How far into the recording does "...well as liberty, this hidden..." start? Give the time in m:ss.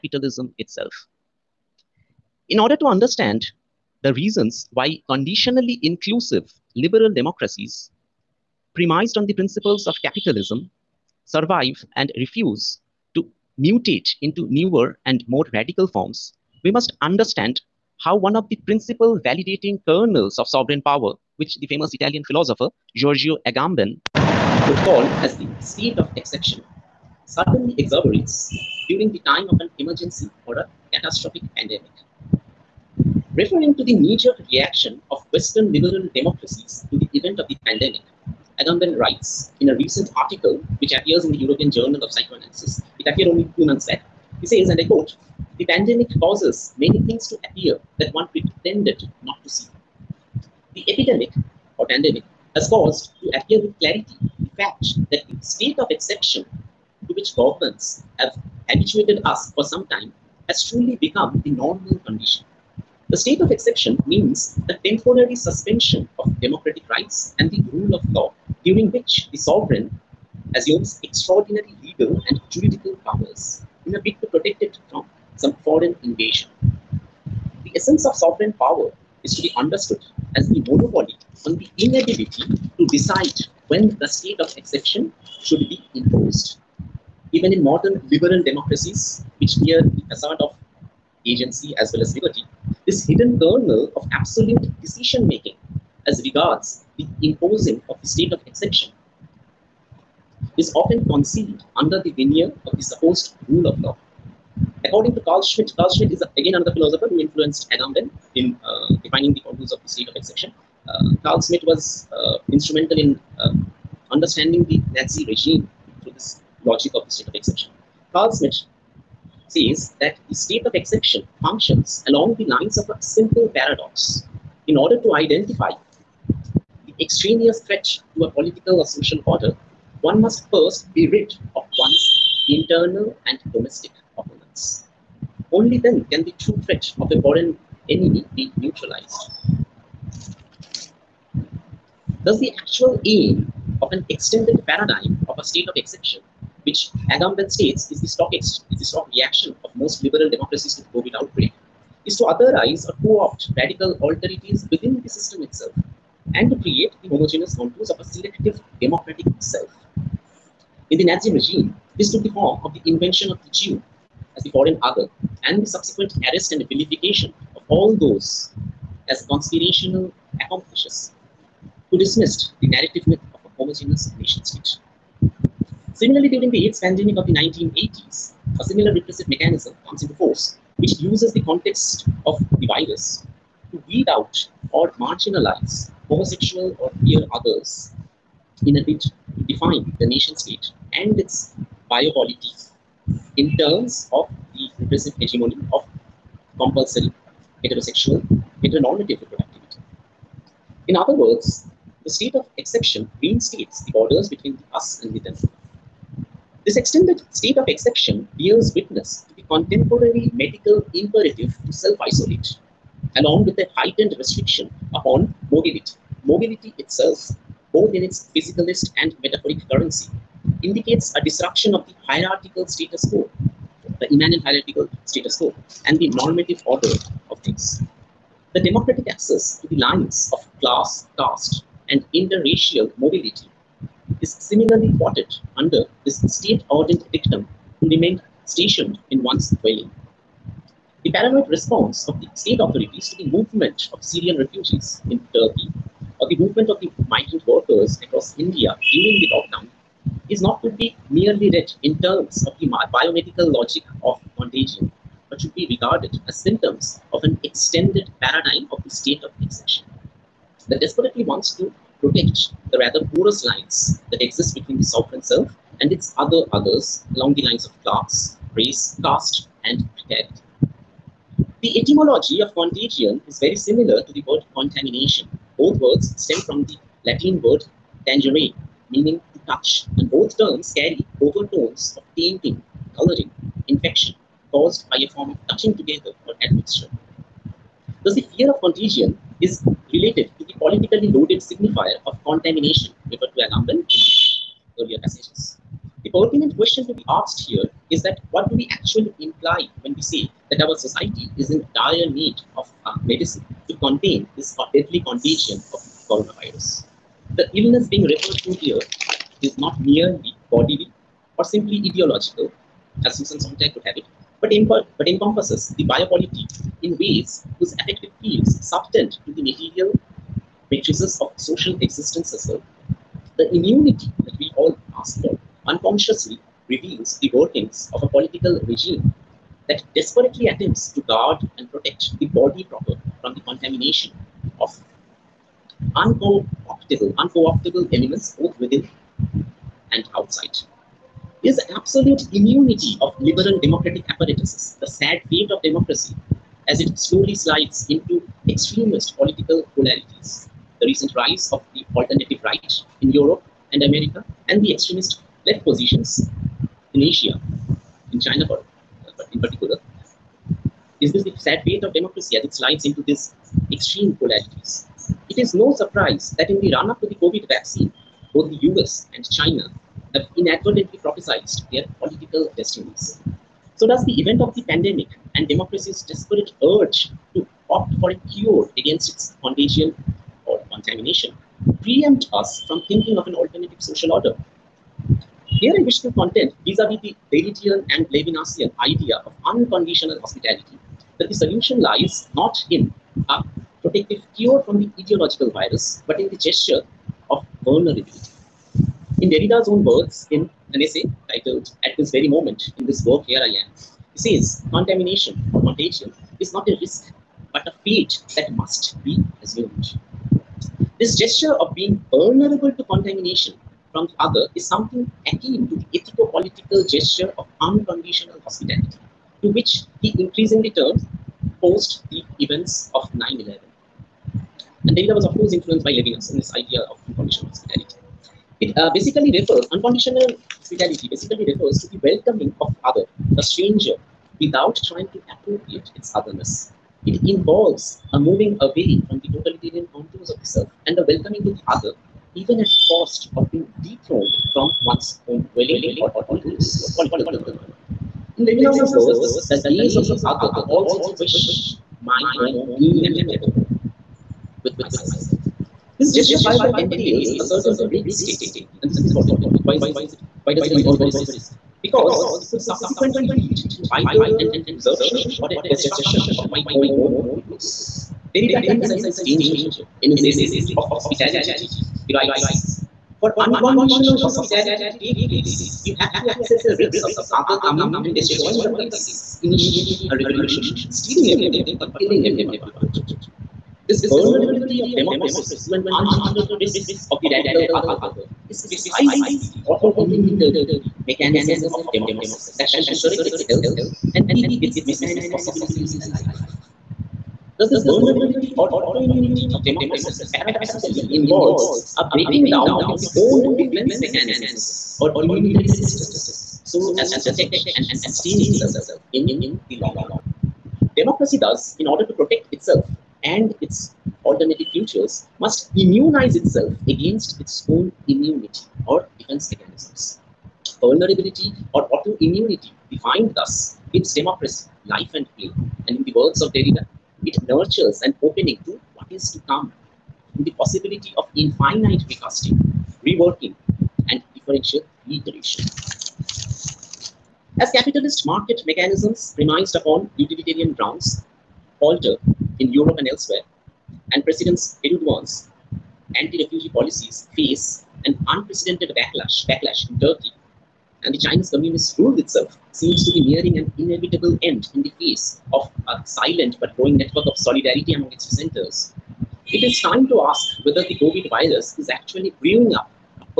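1:31.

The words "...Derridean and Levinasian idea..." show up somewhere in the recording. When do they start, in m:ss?
6:27.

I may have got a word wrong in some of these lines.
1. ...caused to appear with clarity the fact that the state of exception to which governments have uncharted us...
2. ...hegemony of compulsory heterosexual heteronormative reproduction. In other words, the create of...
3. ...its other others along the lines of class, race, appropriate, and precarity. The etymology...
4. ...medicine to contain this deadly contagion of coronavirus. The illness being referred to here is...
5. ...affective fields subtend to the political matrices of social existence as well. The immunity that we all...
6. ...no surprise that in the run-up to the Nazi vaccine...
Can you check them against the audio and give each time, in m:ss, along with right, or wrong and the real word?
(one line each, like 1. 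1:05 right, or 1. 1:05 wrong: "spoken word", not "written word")
1. 0:52 wrong: "habituated", not "uncharted"
2. 3:15 wrong: "state", not "create"
3. 4:25 wrong: "caste", not "appropriate"
4. 5:03 right
5. 5:17 wrong: "material", not "political"
6. 6:05 wrong: "COVID", not "Nazi".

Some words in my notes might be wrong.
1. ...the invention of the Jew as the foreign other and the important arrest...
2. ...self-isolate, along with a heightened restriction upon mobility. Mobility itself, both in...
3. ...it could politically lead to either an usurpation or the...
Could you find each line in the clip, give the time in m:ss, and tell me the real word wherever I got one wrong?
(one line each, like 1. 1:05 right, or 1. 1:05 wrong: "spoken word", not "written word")
1. 2:42 wrong: "subsequent", not "important"
2. 3:31 right
3. 7:42 wrong: "subsequently", not "politically".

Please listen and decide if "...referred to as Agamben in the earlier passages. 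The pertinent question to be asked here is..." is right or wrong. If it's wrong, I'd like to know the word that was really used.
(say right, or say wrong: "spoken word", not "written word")
right.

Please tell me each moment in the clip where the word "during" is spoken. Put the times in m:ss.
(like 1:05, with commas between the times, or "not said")
0:28, 1:08, 2:56, 4:08.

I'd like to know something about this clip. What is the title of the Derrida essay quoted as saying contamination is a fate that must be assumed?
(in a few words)
At This Very Moment, in this work, Here I Am.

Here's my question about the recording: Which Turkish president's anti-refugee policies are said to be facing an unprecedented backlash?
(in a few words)
Erdogan.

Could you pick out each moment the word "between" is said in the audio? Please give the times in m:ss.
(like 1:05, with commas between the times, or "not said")
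3:24, 4:24.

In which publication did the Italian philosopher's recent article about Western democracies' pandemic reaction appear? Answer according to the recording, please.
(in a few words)
European Journal of Psychoanalysis.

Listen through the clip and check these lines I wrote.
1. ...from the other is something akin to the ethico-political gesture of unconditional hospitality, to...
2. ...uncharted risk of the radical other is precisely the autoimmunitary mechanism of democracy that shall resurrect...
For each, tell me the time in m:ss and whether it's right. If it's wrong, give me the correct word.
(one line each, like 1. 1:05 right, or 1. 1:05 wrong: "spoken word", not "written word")
1. 6:53 right
2. 8:05 right.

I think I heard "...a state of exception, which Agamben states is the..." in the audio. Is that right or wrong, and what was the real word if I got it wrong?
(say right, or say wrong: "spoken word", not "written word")
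right.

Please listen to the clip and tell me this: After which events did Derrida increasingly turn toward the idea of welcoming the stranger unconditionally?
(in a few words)
9/11.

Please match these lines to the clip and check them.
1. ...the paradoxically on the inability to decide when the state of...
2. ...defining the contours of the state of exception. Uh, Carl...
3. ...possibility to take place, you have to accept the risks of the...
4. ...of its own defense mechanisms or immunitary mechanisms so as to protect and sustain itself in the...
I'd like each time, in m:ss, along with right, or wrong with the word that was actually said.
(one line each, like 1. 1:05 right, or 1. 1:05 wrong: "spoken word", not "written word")
1. 1:20 wrong: "monopoly", not "paradoxically"
2. 1:49 right
3. 7:54 wrong: "hospitality", not "possibility"
4. 8:22 wrong: "systems", not "mechanisms".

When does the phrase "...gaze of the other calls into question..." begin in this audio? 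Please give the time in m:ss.
7:29.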